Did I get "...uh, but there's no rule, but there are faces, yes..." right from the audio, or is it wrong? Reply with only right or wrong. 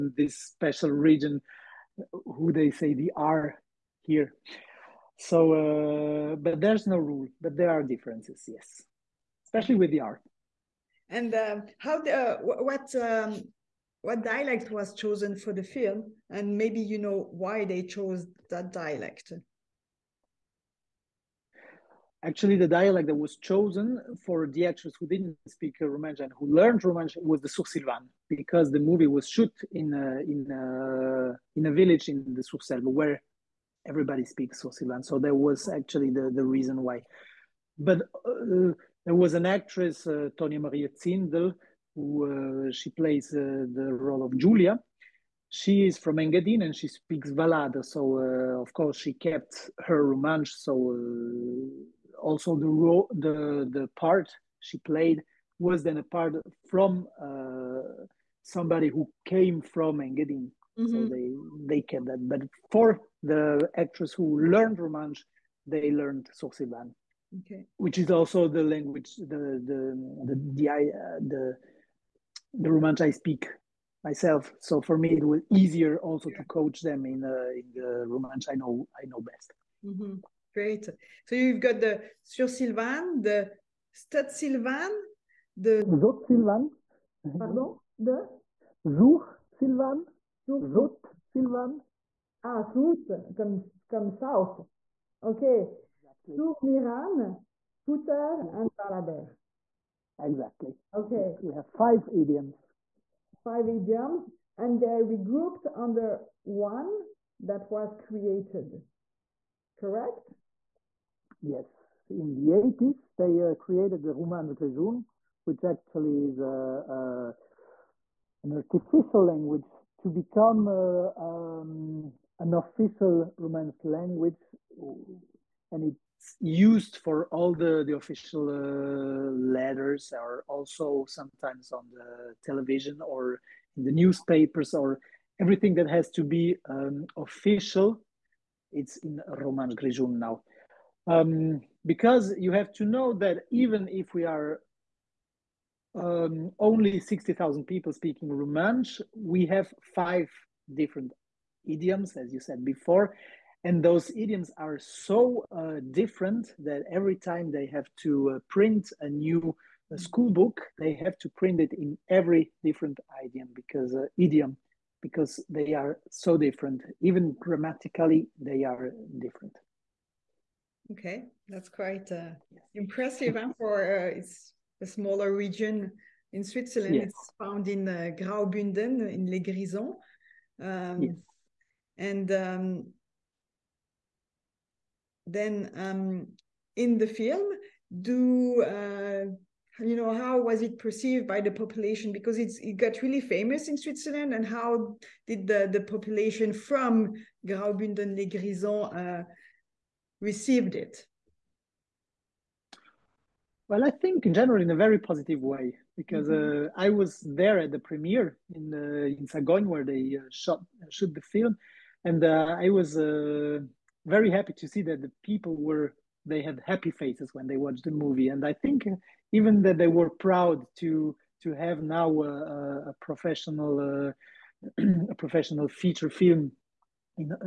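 wrong.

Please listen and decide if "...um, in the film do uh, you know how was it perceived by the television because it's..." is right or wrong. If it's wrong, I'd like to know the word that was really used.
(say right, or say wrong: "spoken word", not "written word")
wrong: "population", not "television".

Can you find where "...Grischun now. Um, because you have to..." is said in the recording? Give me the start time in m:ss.
2:19.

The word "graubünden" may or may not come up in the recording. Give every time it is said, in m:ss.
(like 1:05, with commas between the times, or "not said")
2:58, 3:17.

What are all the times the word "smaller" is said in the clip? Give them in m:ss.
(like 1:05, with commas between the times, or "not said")
2:54.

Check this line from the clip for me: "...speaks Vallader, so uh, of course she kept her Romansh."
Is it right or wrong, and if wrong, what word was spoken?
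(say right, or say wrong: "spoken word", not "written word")
right.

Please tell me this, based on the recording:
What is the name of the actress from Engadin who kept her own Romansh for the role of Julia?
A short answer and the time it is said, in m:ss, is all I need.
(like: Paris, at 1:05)
Tonia Maria Zindel, at 0:40.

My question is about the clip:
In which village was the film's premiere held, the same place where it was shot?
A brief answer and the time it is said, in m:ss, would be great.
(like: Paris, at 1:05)
Sagogn, at 3:29.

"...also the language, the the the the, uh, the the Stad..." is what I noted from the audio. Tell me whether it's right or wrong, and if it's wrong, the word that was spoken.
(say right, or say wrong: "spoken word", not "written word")
wrong: "Romansh", not "Stad".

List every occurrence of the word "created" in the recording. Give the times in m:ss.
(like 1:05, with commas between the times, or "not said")
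1:47, 1:53.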